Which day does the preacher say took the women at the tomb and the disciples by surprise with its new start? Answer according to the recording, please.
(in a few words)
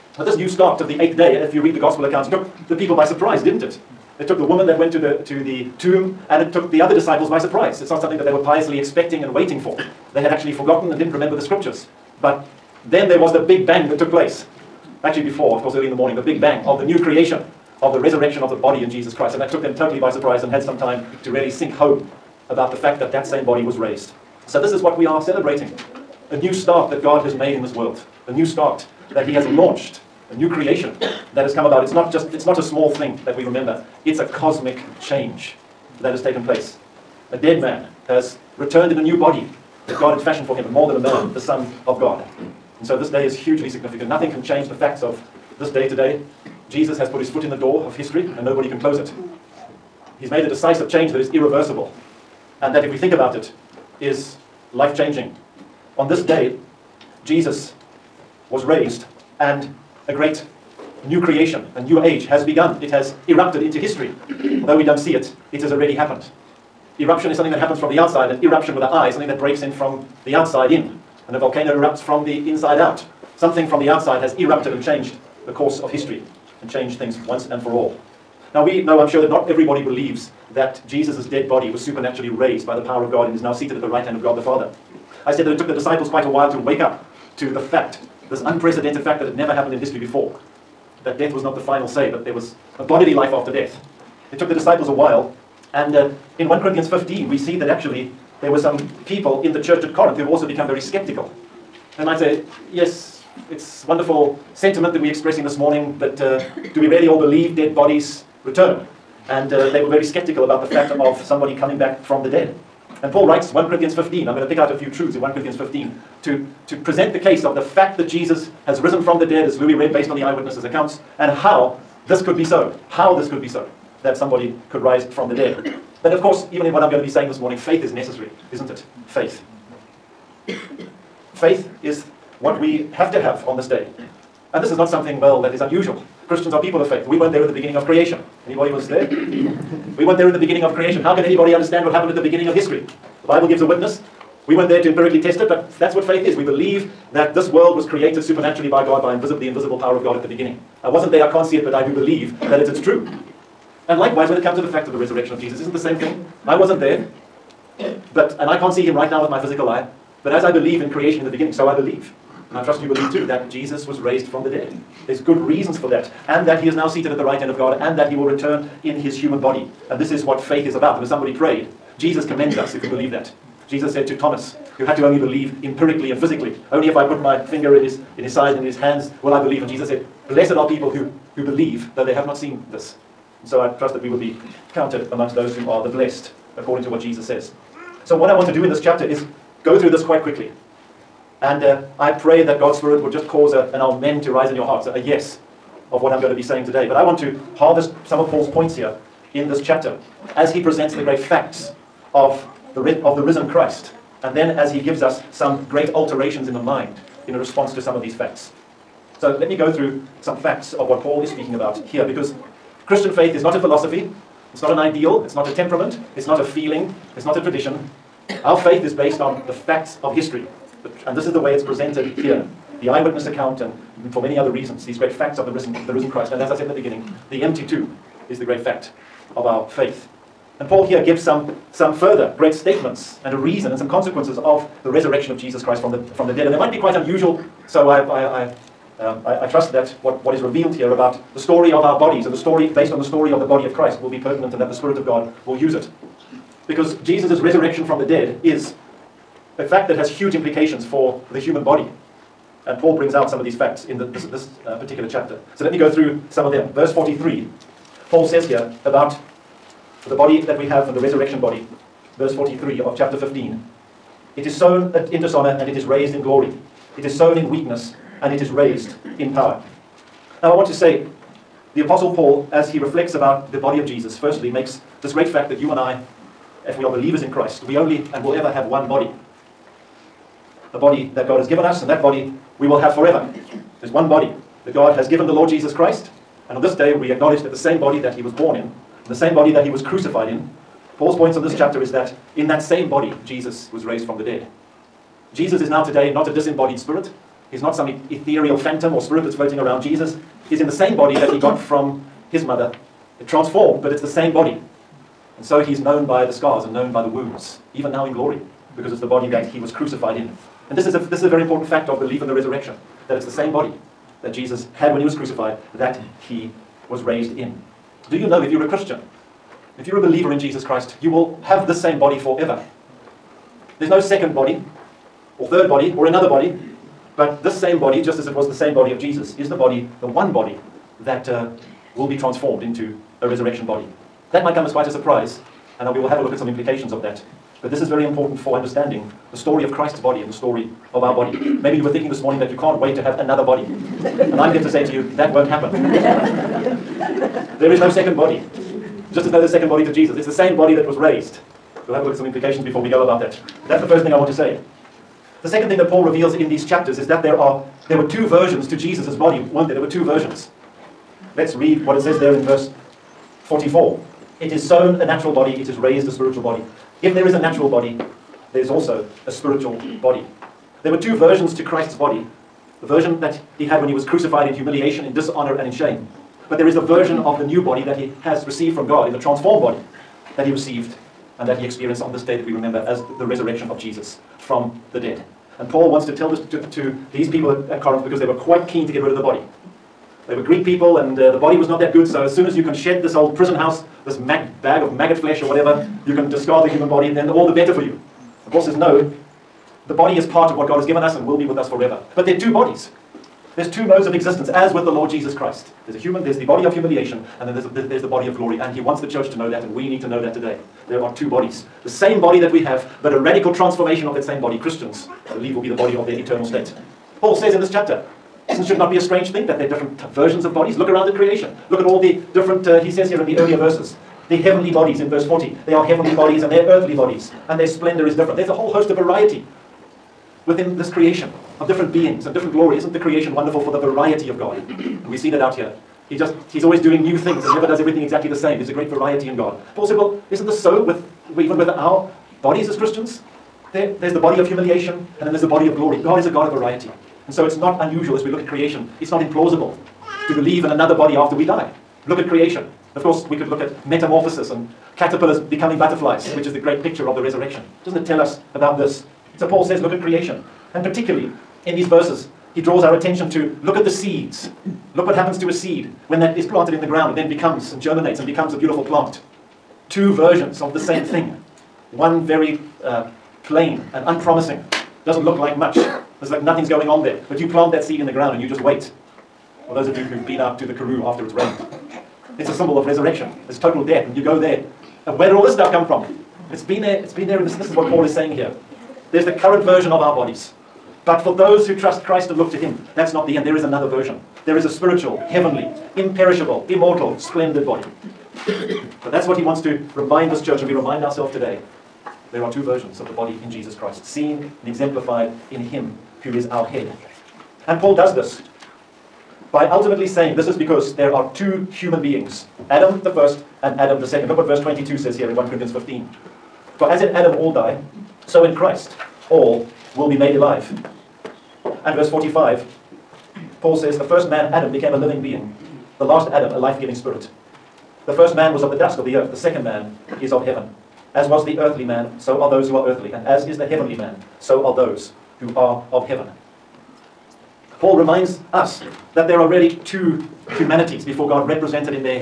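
The eighth day.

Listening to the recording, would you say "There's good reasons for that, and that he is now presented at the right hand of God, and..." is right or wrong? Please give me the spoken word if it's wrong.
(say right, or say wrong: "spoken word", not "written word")
wrong: "seated", not "presented".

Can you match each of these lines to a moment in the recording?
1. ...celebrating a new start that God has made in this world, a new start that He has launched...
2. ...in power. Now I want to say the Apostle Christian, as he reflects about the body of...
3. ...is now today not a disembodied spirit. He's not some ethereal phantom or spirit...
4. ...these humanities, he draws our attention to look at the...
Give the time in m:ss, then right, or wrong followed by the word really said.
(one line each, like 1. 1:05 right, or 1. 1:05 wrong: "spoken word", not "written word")
1. 0:25 right
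2. 4:29 wrong: "Paul", not "Christian"
3. 4:55 right
4. 7:41 wrong: "verses", not "humanities".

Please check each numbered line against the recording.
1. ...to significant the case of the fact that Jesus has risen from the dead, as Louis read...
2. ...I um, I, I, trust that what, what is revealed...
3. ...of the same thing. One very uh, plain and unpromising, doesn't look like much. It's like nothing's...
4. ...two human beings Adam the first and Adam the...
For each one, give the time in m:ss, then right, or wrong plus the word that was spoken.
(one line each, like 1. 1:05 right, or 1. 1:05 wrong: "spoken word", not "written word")
1. 1:56 wrong: "present", not "significant"
2. 3:58 right
3. 7:50 right
4. 8:31 right.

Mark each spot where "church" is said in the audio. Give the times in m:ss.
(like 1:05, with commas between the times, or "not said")
1:39, 6:49, 8:20.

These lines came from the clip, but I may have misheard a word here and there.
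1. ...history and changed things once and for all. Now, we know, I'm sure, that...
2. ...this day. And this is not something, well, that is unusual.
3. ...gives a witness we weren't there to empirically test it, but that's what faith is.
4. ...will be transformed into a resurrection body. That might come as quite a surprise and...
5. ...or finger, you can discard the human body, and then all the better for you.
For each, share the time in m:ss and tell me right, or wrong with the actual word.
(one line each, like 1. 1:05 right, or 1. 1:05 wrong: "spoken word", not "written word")
1. 1:15 right
2. 2:13 right
3. 2:23 right
4. 5:31 right
5. 6:35 wrong: "whatever", not "finger".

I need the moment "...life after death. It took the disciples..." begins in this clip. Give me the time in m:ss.
1:33.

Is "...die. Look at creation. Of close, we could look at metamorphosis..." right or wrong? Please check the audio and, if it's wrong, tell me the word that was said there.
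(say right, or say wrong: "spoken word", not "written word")
wrong: "course", not "close".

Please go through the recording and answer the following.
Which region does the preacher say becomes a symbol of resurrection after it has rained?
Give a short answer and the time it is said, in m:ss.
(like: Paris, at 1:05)
The Karoo, at 8:00.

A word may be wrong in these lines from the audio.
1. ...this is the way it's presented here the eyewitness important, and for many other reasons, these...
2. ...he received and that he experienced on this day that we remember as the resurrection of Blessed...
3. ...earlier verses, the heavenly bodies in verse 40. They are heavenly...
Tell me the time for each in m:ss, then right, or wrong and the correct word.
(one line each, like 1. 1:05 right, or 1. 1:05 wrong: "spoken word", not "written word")
1. 3:41 wrong: "account", not "important"
2. 6:20 wrong: "Jesus", not "Blessed"
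3. 7:03 right.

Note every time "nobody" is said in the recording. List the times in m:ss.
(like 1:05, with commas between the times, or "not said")
0:48.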